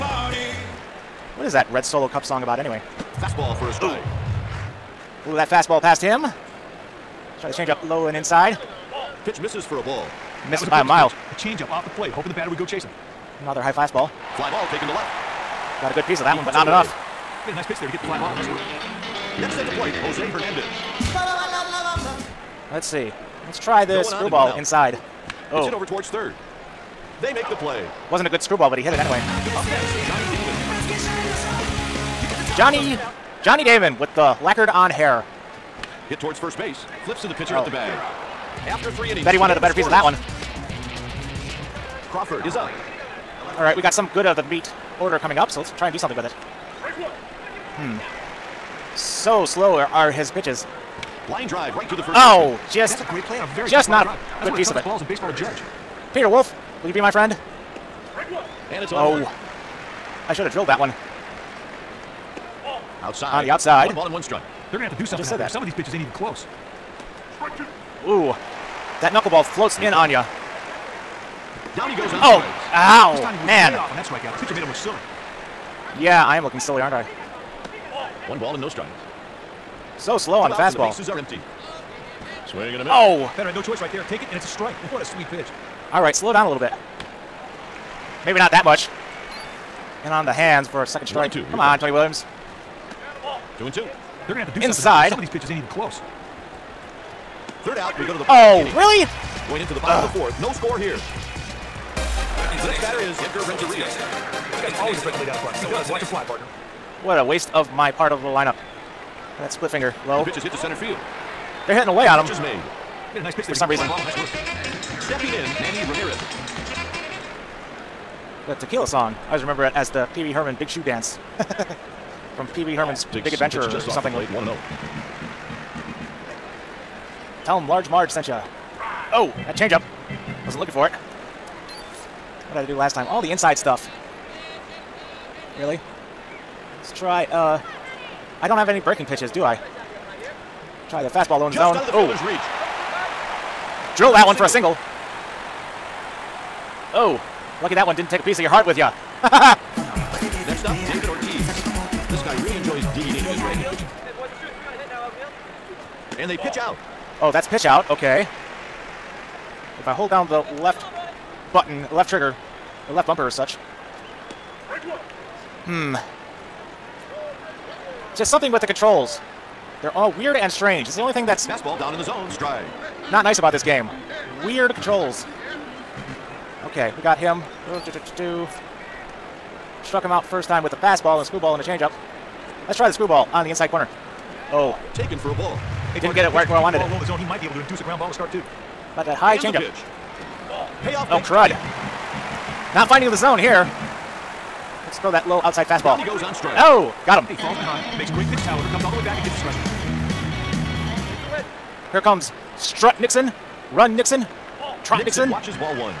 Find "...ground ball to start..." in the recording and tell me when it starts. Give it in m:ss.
3:07.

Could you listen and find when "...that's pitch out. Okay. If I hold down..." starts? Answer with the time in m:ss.
2:37.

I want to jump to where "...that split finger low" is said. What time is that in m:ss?
1:49.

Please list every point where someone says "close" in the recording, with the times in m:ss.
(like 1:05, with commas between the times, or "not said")
1:06, 1:35.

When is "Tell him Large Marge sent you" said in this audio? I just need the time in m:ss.
2:07.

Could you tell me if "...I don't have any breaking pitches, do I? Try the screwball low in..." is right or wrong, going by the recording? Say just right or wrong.
wrong.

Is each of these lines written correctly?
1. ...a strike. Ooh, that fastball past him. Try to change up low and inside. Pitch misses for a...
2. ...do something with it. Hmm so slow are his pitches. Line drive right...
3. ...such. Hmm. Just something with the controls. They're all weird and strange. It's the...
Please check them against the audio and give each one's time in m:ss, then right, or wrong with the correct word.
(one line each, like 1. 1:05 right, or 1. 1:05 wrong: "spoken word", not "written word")
1. 0:03 right
2. 0:45 right
3. 2:43 right.